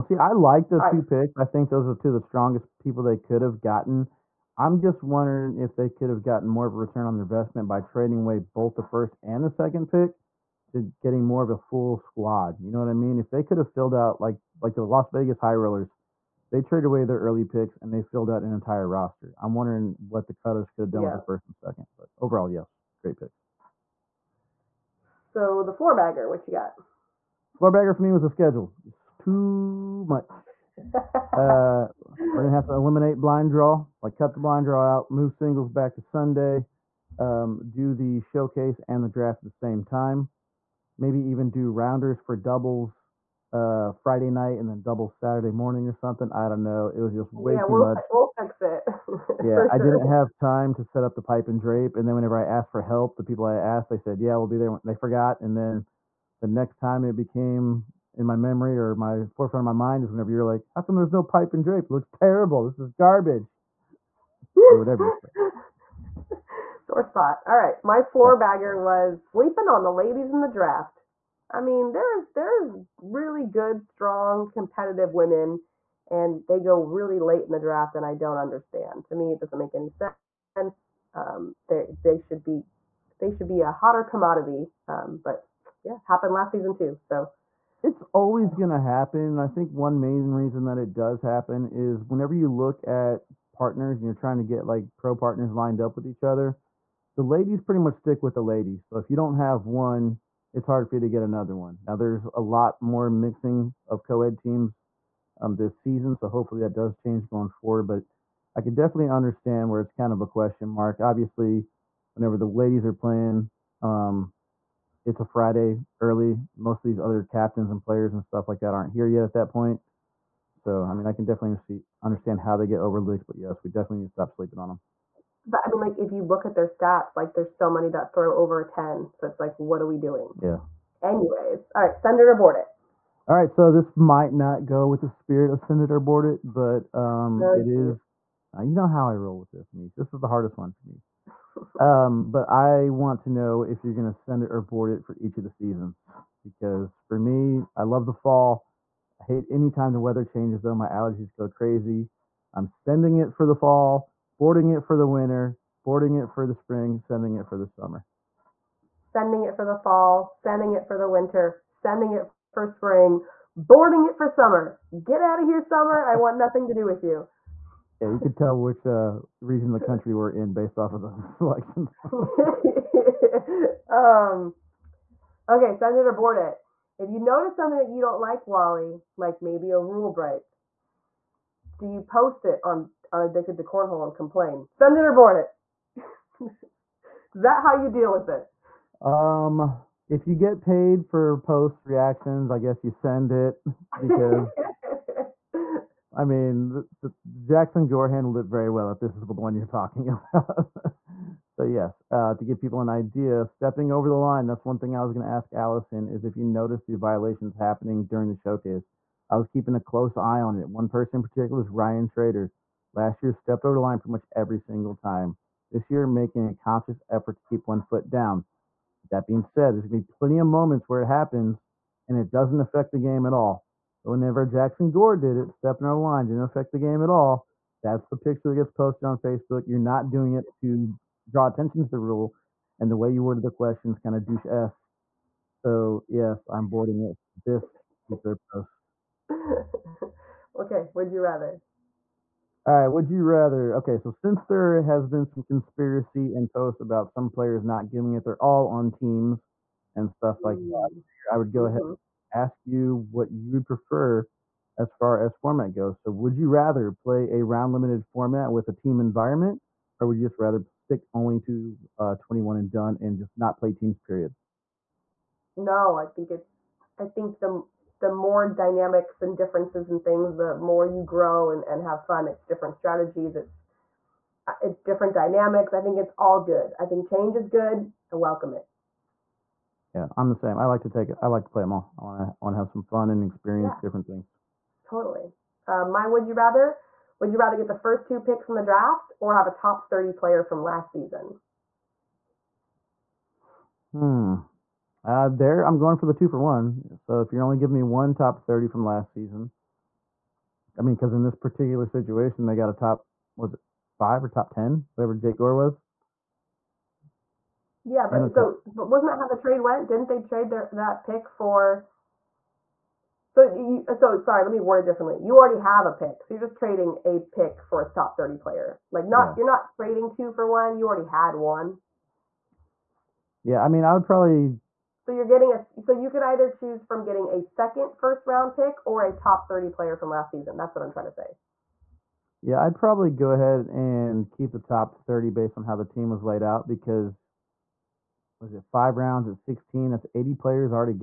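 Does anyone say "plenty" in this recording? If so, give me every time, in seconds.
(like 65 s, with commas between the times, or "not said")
220 s.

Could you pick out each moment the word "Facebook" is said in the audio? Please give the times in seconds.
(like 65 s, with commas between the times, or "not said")
229 s.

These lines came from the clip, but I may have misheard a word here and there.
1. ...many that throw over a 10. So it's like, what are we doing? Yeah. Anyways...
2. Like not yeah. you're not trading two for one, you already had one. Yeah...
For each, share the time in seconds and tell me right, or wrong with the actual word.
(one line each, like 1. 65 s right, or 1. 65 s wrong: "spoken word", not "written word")
1. 127 s right
2. 318 s right.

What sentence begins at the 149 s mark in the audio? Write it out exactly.
I hate anytime the weather changes, though.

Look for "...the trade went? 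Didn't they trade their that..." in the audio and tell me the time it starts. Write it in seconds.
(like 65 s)
309 s.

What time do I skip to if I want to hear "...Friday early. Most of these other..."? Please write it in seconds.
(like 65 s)
115 s.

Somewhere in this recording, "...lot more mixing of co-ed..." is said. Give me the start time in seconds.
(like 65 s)
102 s.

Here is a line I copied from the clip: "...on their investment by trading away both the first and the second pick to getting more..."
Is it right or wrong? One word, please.
right.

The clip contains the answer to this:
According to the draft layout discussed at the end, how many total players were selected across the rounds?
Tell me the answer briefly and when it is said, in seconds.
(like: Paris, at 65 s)
80, at 340 s.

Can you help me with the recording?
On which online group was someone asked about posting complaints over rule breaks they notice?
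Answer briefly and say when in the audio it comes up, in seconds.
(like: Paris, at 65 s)
Addicted to Cornhole, at 183 s.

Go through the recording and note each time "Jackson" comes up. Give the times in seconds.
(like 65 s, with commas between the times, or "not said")
197 s, 224 s.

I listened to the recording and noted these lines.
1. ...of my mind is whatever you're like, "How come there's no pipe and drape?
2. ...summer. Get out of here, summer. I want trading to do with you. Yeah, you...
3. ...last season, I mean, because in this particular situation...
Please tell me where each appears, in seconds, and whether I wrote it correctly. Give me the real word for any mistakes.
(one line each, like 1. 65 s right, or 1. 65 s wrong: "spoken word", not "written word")
1. 59 s wrong: "whenever", not "whatever"
2. 164 s wrong: "nothing", not "trading"
3. 298 s right.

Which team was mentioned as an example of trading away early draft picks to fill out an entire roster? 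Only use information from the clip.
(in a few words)
Las Vegas High Rollers.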